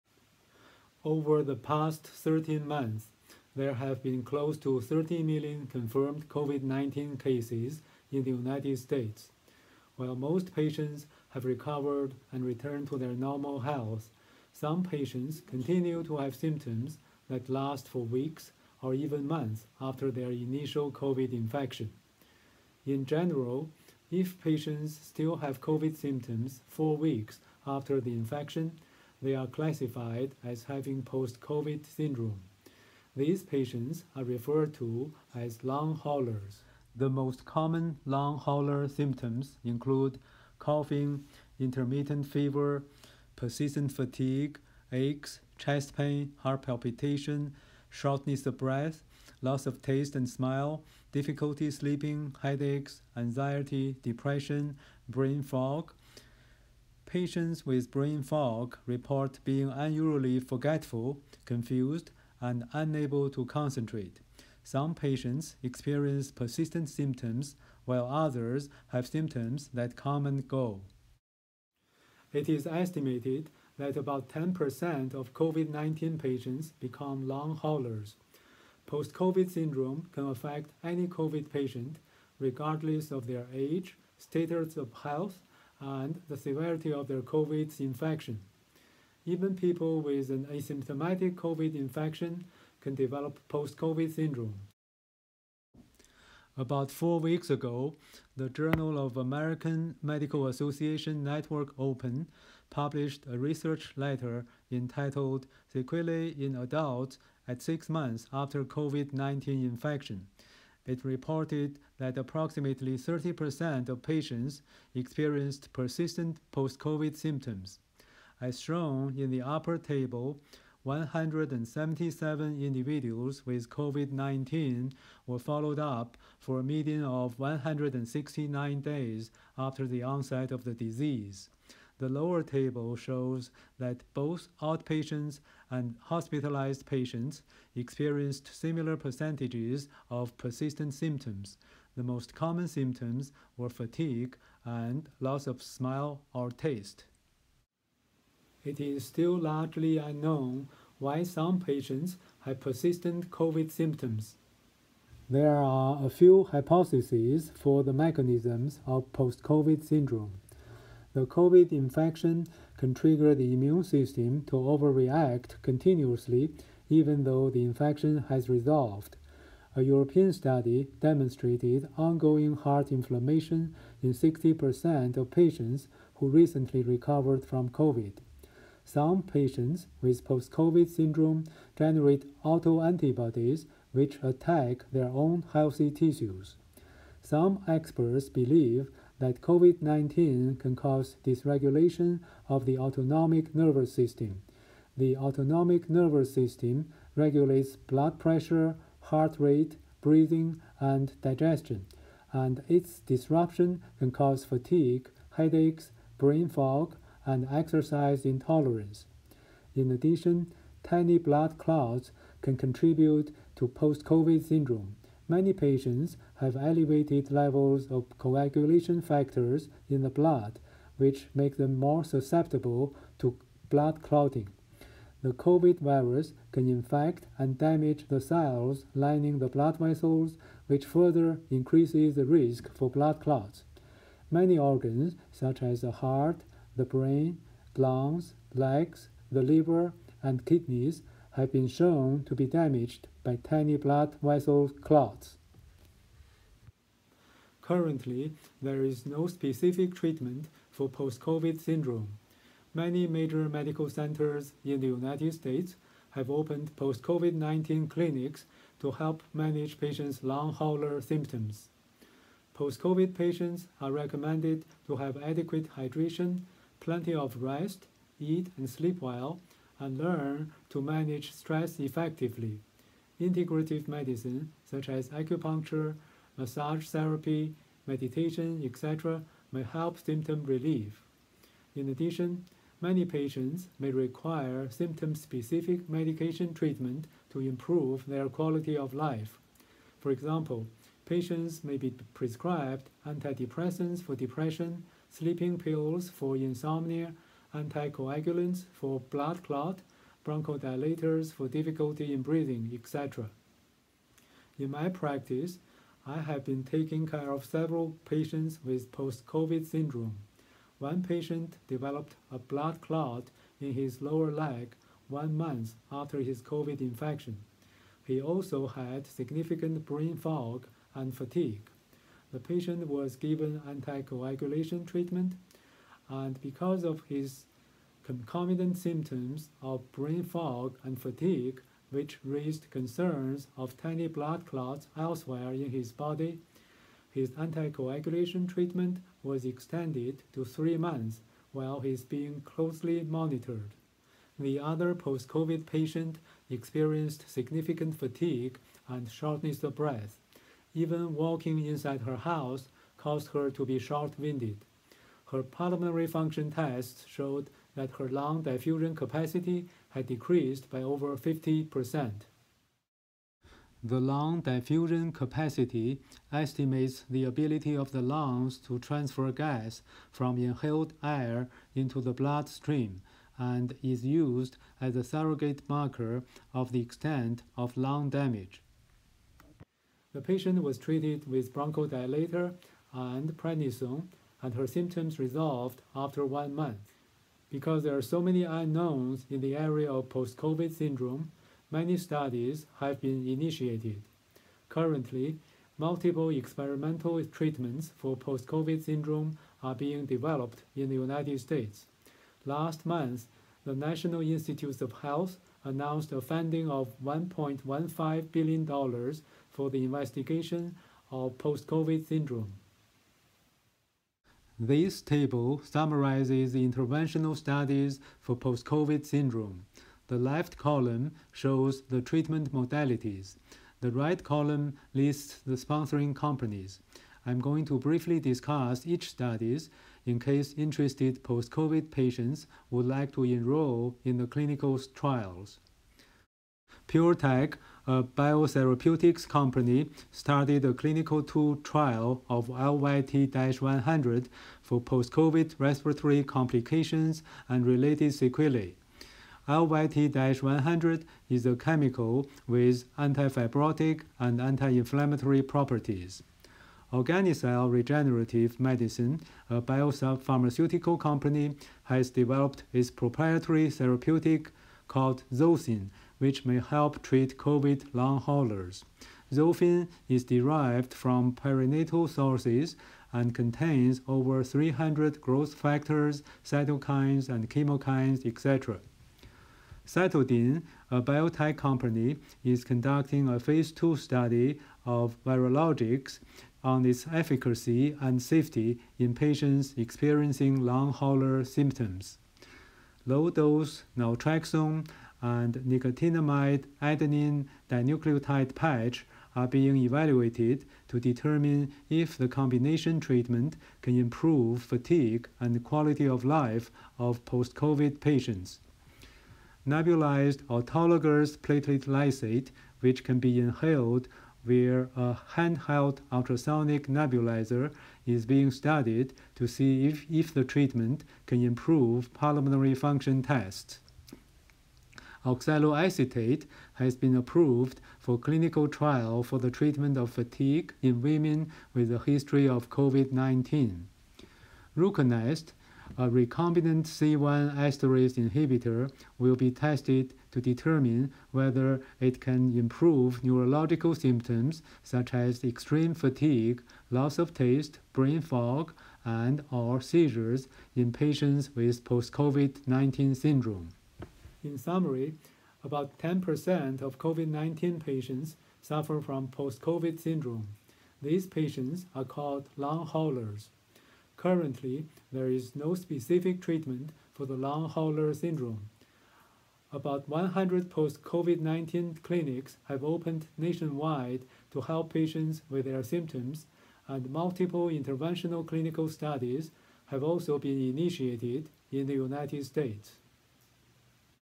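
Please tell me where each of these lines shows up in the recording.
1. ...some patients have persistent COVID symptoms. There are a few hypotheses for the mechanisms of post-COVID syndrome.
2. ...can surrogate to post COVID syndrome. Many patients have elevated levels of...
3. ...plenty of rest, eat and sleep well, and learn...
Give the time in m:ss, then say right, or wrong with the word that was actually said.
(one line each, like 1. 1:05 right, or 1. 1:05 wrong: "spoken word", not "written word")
1. 2:31 right
2. 3:32 wrong: "contribute", not "surrogate"
3. 4:26 right.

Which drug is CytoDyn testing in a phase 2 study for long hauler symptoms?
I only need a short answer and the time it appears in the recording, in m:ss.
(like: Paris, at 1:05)
Vyrologix, at 8:05.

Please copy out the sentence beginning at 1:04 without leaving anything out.
Some patients experience persistent symptoms, while others have symptoms that come and go.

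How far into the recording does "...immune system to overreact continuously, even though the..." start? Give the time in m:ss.
2:43.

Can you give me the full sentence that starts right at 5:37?
His anticoagulation treatment was extended to three months while he's being closely monitored.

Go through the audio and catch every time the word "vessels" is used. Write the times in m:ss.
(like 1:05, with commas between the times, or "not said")
3:49, 4:04.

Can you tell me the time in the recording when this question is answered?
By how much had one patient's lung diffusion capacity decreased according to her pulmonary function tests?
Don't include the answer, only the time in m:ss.
6:00.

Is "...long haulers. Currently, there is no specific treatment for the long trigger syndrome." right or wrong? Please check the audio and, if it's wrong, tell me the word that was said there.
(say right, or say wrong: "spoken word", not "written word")
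wrong: "hauler", not "trigger".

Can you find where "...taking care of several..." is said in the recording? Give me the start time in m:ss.
5:06.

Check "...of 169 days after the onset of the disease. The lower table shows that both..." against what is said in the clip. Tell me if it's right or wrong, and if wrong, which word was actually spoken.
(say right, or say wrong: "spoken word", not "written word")
right.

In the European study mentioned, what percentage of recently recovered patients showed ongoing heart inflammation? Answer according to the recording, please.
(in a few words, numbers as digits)
60%.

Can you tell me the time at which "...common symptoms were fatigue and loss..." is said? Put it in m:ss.
2:22.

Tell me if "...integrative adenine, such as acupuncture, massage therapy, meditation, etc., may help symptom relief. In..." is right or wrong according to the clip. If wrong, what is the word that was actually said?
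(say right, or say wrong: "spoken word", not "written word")
wrong: "medicine", not "adenine".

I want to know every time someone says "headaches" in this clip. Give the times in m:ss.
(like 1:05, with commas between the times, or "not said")
0:52, 3:25.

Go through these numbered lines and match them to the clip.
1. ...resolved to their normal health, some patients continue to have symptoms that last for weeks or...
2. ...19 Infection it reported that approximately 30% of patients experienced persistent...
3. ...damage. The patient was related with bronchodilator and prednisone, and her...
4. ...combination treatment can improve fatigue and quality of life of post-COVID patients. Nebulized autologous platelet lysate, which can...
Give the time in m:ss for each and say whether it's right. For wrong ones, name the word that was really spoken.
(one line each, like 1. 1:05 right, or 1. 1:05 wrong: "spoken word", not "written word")
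1. 0:12 wrong: "returned", not "resolved"
2. 1:49 right
3. 6:18 wrong: "treated", not "related"
4. 8:22 right.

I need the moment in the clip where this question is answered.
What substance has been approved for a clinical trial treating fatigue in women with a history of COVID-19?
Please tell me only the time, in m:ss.
8:45.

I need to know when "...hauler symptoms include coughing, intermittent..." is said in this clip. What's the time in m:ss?
0:38.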